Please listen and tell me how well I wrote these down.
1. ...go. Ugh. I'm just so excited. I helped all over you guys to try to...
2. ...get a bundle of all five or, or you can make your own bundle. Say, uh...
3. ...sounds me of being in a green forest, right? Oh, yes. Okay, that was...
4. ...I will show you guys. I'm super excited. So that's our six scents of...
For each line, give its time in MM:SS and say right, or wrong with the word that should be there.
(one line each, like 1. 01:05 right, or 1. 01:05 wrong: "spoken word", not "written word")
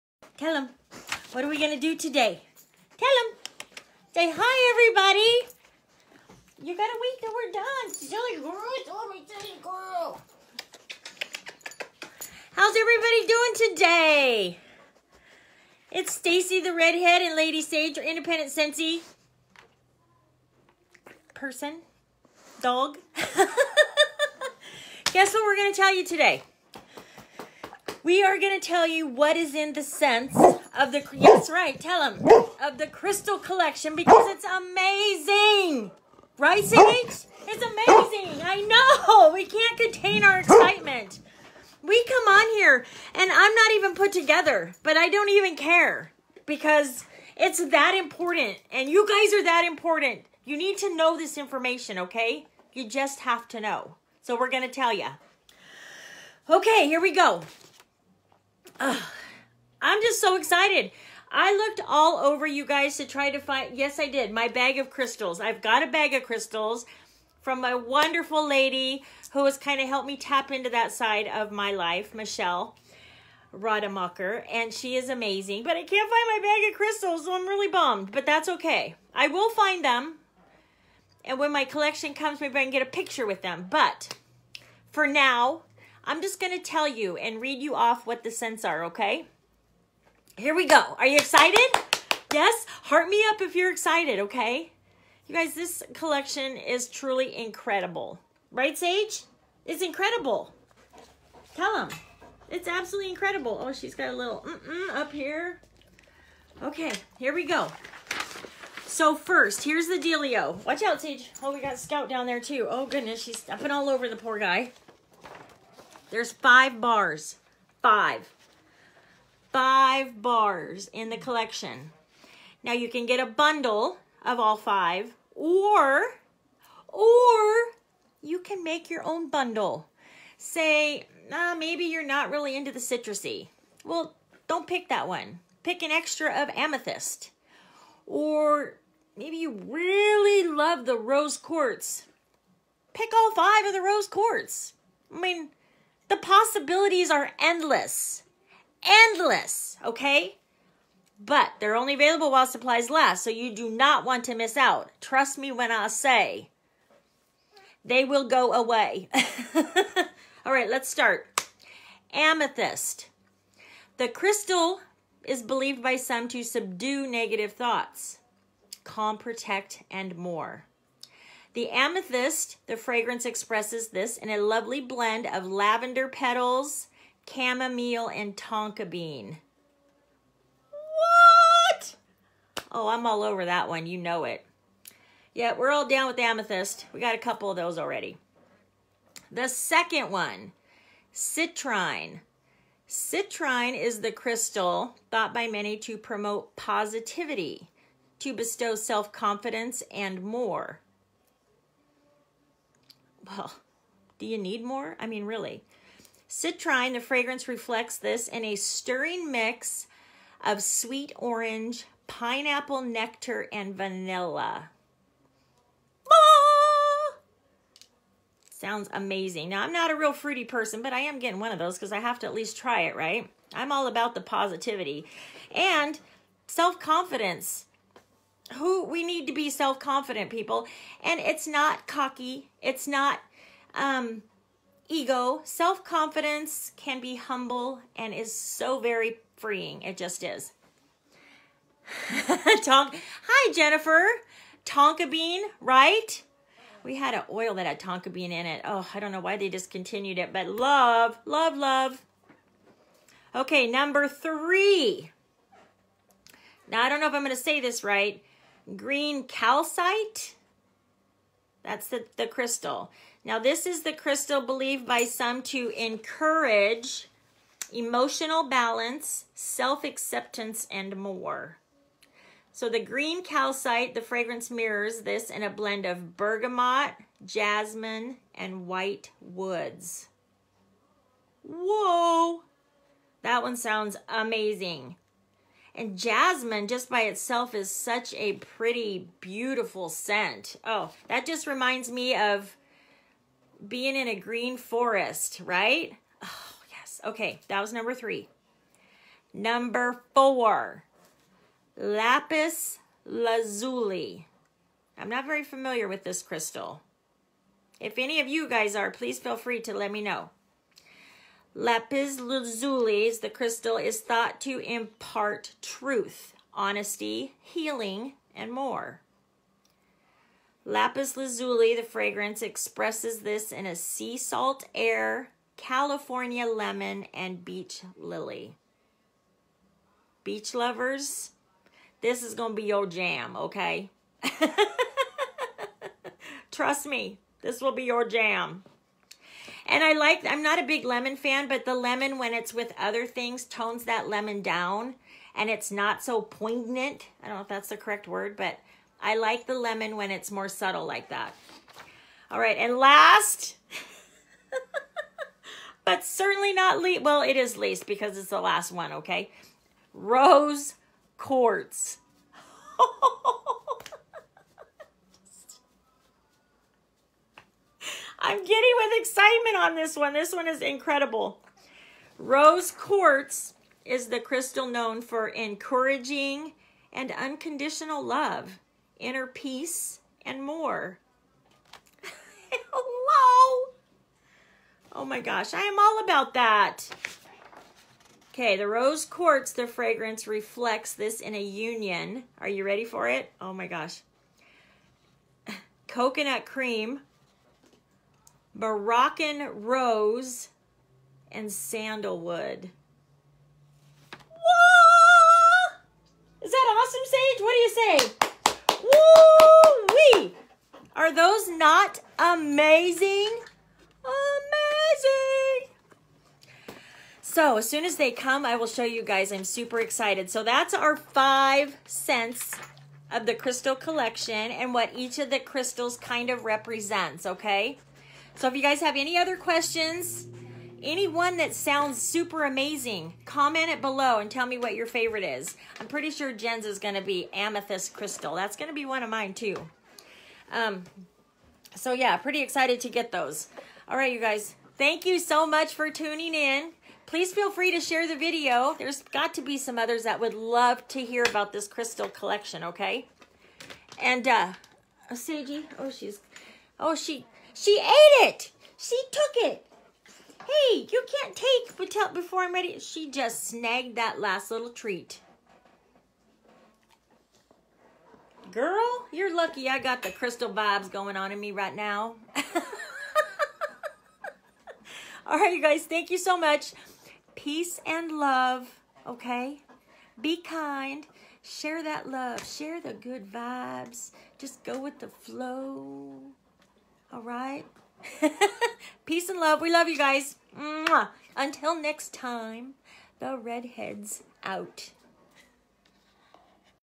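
1. 00:57 wrong: "looked", not "helped"
2. 02:03 right
3. 04:51 wrong: "reminds", not "sounds"
4. 06:58 wrong: "five", not "six".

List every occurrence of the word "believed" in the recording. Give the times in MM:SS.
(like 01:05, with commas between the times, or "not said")
02:45, 04:24.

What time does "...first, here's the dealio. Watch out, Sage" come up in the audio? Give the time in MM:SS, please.
01:49.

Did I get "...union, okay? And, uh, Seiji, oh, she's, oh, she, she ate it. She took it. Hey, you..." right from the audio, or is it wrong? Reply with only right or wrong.
wrong.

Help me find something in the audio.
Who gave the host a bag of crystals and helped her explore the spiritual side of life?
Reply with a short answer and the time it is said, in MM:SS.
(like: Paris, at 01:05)
Michelle Rademacher, at 01:12.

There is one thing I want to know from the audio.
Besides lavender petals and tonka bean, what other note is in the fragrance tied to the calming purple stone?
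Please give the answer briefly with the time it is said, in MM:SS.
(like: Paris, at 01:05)
chamomile, at 02:57.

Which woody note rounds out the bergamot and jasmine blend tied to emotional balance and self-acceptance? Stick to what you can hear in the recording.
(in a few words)
white woods.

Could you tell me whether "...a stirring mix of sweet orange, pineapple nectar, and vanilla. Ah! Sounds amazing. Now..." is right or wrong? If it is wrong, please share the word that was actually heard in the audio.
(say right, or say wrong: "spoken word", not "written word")
right.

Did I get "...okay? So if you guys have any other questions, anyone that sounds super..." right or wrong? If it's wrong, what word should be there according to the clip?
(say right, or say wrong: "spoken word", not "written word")
right.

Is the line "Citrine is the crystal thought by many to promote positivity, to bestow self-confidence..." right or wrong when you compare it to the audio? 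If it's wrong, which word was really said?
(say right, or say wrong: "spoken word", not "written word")
right.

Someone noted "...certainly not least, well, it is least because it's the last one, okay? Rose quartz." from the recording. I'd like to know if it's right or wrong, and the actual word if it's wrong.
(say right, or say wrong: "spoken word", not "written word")
right.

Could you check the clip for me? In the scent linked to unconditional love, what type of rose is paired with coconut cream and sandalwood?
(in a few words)
Moroccan rose.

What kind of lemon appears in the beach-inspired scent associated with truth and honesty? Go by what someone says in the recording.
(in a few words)
California lemon.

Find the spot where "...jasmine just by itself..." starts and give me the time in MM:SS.
04:45.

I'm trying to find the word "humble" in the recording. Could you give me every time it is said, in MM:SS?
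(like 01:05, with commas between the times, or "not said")
03:57.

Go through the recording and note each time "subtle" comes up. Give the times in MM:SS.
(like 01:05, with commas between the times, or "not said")
05:50.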